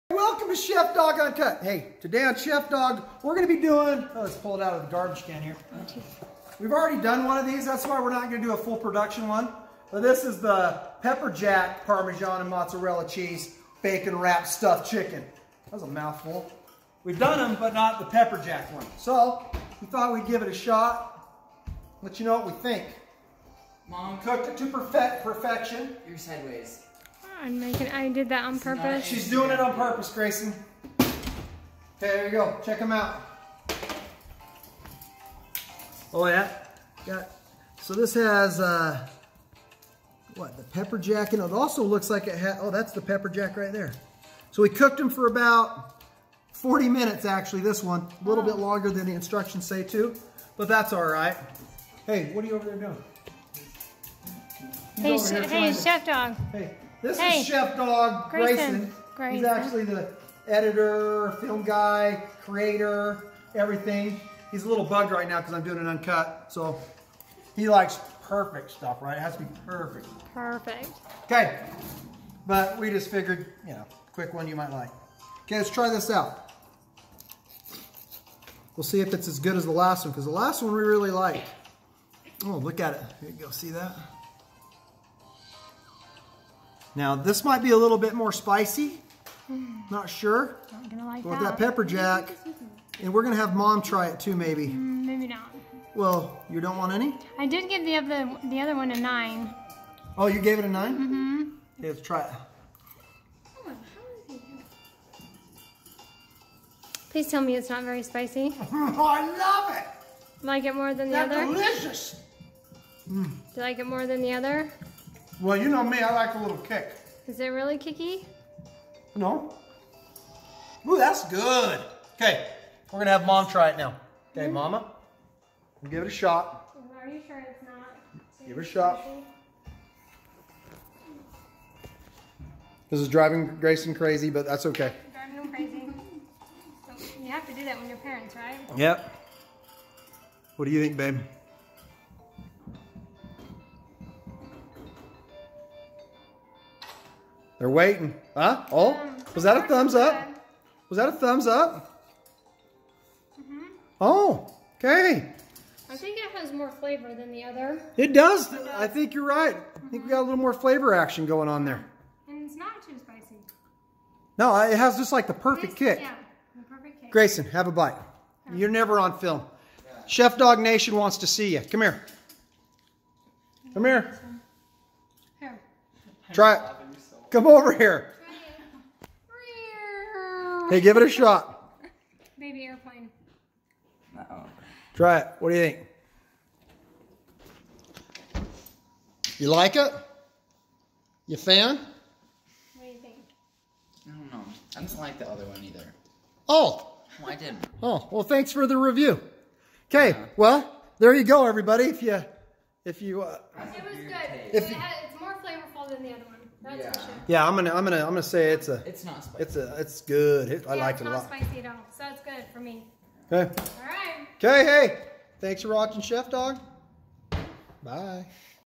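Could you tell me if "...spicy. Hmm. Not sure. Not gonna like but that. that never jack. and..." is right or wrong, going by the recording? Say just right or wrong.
wrong.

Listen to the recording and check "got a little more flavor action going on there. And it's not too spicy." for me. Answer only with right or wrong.
right.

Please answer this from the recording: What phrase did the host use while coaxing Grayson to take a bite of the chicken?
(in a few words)
Baby airplane.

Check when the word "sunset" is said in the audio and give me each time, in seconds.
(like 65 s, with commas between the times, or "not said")
not said.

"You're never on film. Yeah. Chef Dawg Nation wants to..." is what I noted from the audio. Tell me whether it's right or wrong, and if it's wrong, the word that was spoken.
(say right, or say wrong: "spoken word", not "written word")
right.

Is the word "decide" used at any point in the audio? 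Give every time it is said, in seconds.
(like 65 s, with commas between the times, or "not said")
not said.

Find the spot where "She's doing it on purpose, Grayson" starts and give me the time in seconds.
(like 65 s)
29 s.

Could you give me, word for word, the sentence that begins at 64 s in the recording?
He's a little bugged right now because I'm doing an uncut.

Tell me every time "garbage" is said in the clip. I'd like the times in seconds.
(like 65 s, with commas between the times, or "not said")
4 s.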